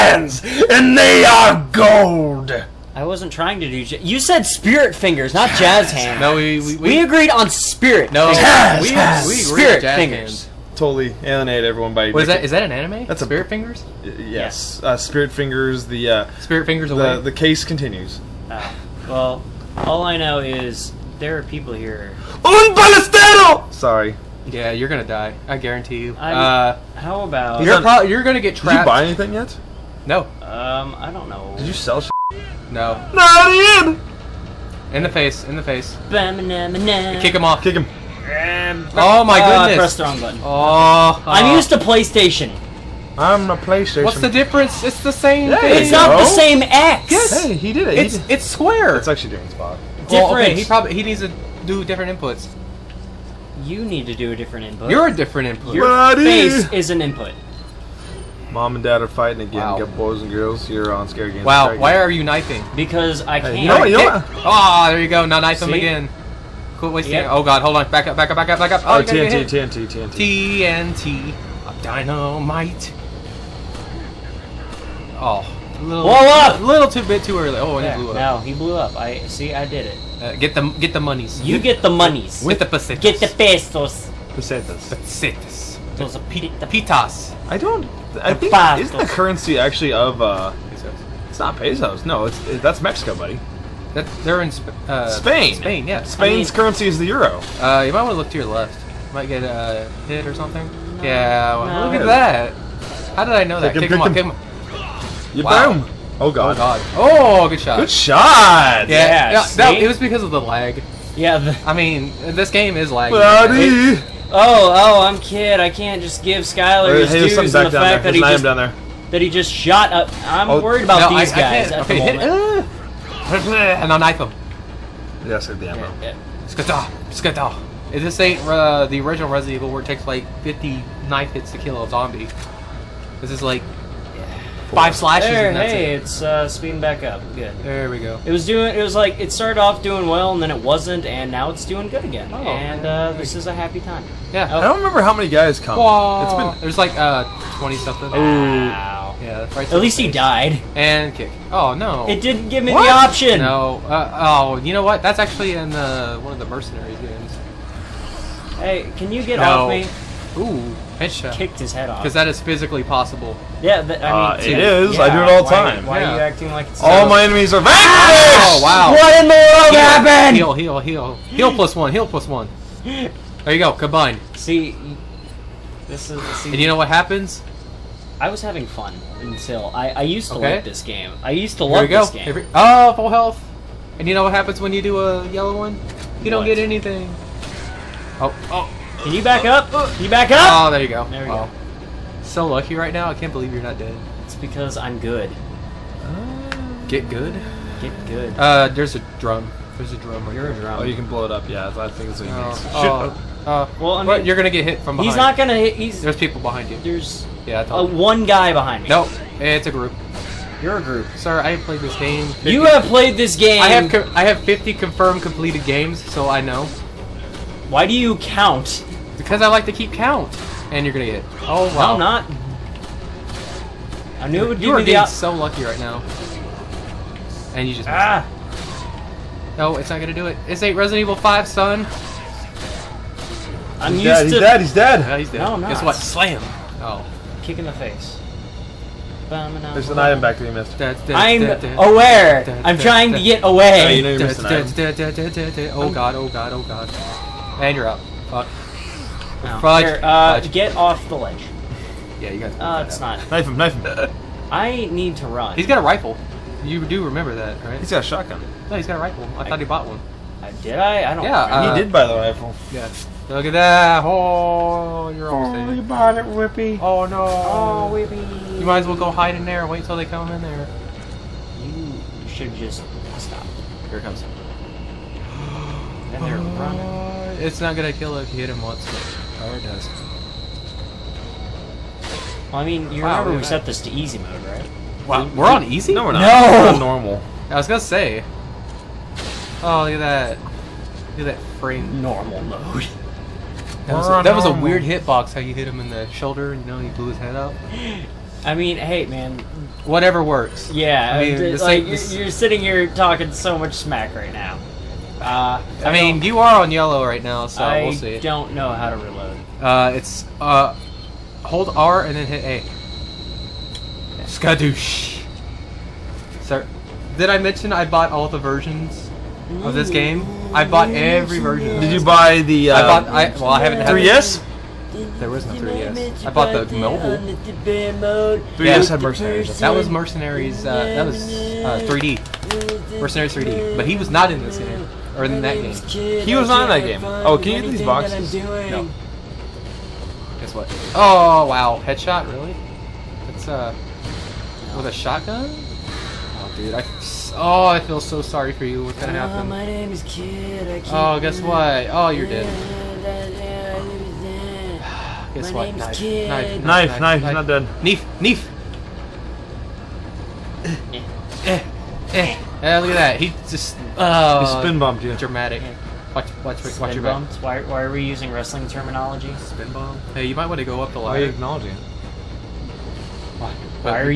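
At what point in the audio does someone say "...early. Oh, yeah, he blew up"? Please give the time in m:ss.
1:17.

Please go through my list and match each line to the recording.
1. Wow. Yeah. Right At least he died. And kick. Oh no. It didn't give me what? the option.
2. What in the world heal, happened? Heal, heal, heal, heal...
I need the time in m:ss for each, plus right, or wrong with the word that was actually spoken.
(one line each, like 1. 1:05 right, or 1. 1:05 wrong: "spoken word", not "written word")
1. 2:28 right
2. 2:48 right.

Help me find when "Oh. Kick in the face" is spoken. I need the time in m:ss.
3:56.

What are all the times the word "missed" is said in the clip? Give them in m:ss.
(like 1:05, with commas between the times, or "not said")
4:00.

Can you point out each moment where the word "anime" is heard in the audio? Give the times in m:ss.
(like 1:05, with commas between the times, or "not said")
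0:12.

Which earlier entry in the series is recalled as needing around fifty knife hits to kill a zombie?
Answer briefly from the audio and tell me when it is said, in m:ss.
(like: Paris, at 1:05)
The original Resident Evil, at 2:08.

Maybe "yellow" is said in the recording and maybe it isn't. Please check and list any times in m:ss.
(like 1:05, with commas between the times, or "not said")
3:05, 5:06.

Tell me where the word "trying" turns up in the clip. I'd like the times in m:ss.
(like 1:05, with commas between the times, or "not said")
0:03, 4:02.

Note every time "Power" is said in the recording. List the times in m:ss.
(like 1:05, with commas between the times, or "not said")
4:39.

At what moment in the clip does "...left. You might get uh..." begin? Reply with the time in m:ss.
1:38.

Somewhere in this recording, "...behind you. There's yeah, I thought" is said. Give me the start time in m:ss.
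3:26.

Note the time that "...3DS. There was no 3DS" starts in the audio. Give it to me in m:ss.
5:23.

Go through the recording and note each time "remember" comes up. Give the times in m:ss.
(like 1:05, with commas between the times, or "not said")
2:24, 4:17, 4:43.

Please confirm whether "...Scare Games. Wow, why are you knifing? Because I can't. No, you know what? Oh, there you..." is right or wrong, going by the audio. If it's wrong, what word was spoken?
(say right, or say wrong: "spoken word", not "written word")
right.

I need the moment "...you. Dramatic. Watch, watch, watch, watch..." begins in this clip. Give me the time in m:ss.
6:05.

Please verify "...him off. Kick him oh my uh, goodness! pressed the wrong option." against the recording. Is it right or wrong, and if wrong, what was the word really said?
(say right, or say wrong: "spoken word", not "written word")
wrong: "button", not "option".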